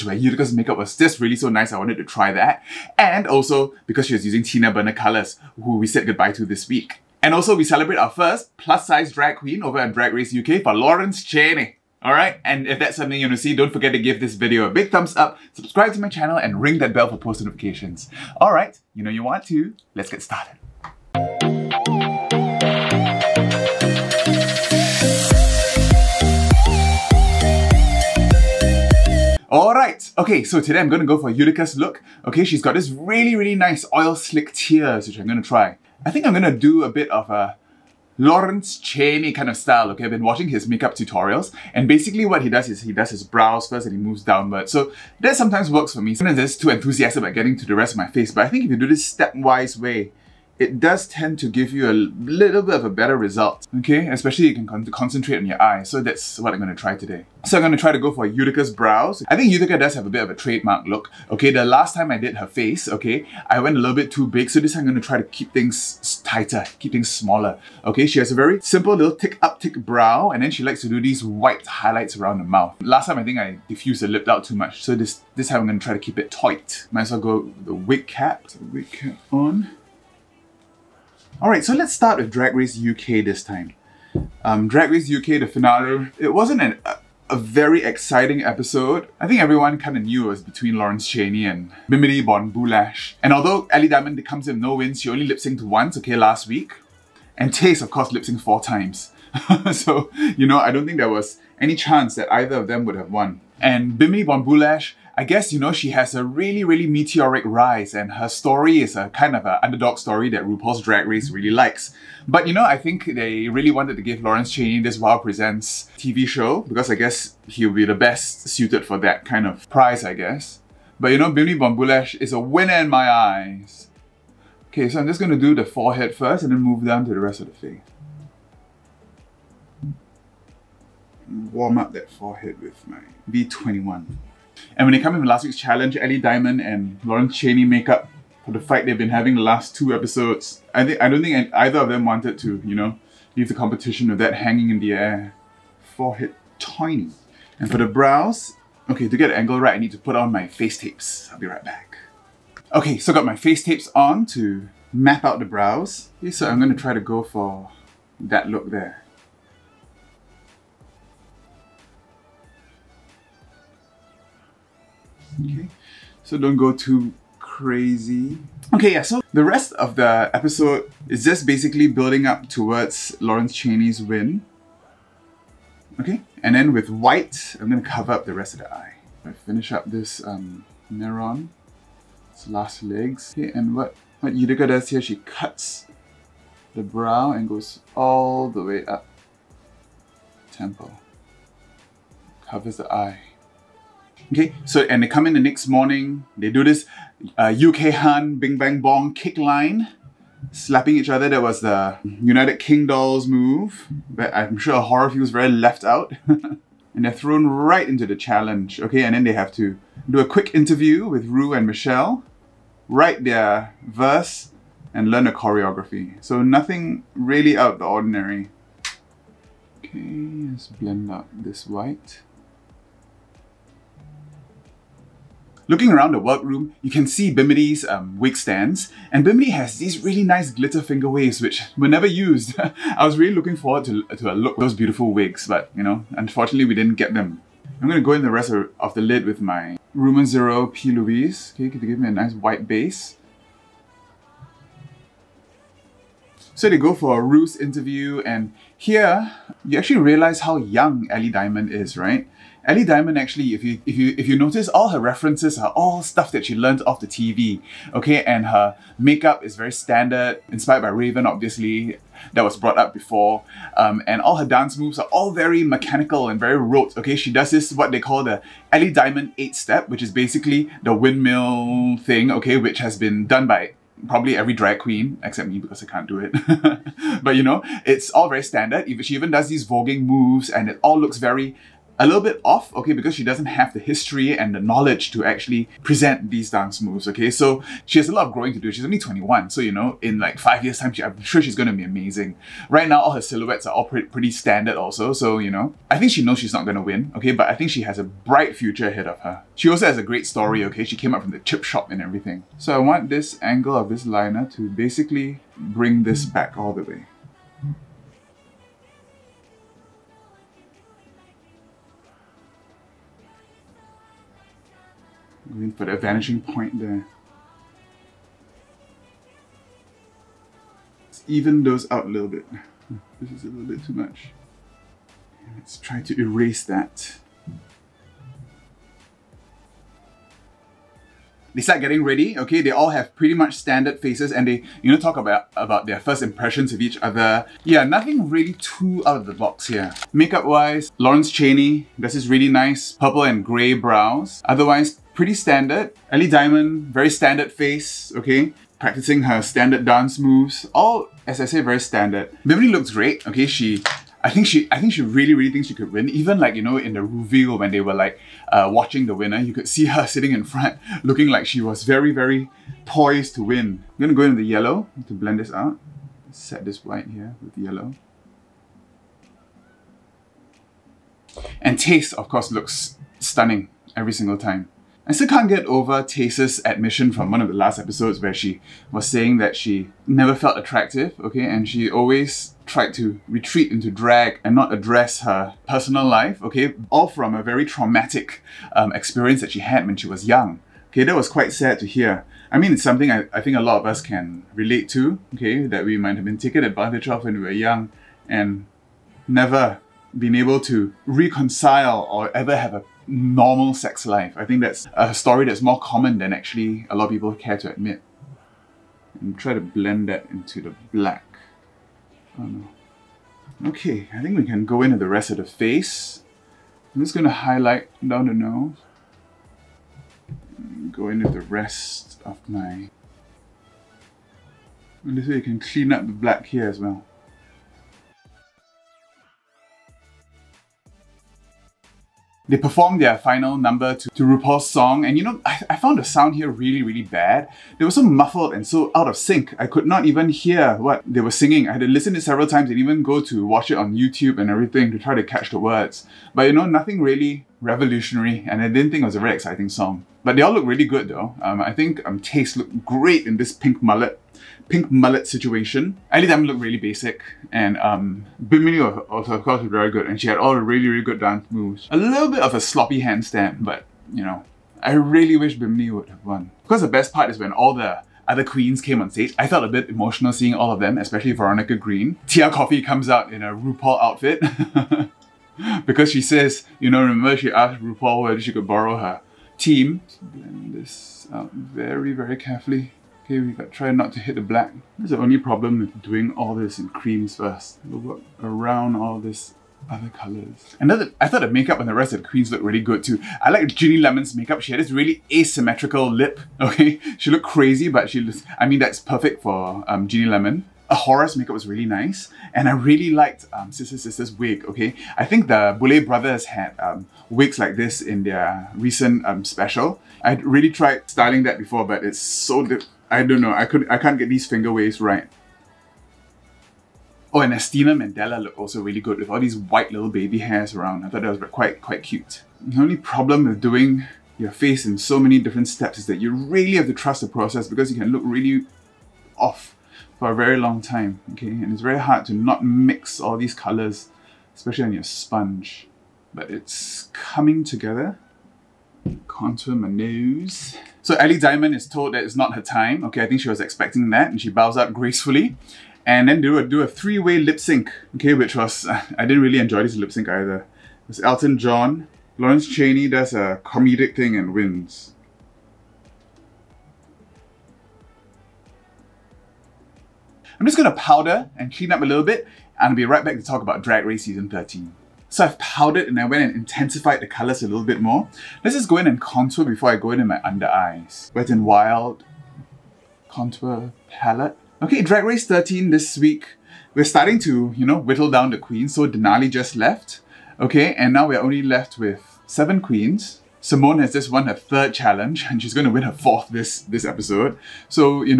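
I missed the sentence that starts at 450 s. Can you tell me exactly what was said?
But they all look really good though.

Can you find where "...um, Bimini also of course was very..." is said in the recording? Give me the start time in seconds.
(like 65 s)
457 s.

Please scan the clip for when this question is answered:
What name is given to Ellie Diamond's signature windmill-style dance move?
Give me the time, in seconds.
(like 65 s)
268 s.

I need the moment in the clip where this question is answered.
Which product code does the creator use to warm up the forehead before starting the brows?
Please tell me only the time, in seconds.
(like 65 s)
133 s.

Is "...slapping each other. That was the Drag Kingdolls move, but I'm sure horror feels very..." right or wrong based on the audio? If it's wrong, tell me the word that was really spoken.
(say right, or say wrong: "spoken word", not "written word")
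wrong: "United", not "Drag".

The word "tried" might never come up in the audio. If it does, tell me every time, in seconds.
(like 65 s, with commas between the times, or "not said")
382 s, 510 s.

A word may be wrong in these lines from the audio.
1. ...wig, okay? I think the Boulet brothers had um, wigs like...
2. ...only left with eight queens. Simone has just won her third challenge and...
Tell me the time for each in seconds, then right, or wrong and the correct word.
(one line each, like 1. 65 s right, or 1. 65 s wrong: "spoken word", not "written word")
1. 504 s right
2. 581 s wrong: "seven", not "eight".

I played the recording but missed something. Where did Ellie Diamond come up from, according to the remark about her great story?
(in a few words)
The chip shop.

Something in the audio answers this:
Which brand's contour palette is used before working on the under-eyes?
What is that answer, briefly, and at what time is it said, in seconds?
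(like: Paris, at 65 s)
Wet and Wild, at 571 s.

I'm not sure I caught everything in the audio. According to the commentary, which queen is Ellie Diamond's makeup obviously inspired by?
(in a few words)
Raven.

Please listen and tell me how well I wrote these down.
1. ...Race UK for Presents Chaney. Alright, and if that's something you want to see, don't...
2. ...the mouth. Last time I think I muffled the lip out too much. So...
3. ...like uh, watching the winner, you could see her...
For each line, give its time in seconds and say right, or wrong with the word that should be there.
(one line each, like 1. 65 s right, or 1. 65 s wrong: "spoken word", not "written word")
1. 10 s wrong: "Lawrence", not "Presents"
2. 72 s wrong: "diffused", not "muffled"
3. 357 s right.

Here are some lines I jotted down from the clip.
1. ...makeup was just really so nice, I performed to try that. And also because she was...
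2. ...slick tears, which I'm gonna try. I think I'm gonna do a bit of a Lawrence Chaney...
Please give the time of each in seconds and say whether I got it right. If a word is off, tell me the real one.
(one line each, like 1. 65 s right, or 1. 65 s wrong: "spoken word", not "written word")
1. 0 s wrong: "wanted", not "performed"
2. 34 s right.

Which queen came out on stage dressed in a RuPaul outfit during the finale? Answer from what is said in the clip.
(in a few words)
Tia Kofi.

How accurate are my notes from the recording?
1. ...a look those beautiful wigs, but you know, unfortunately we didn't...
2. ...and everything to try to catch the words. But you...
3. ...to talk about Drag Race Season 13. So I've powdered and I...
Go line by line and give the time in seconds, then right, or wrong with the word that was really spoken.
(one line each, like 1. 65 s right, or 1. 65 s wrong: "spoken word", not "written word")
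1. 234 s right
2. 444 s right
3. 563 s right.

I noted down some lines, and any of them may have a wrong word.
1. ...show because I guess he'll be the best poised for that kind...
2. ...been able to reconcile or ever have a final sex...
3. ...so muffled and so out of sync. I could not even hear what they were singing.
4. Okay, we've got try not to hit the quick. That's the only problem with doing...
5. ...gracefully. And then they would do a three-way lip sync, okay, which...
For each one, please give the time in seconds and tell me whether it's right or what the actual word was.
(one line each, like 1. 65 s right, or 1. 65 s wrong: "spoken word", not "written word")
1. 116 s wrong: "suited", not "poised"
2. 400 s wrong: "normal", not "final"
3. 437 s right
4. 483 s wrong: "black", not "quick"
5. 544 s right.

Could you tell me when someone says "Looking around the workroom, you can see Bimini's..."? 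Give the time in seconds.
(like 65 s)
225 s.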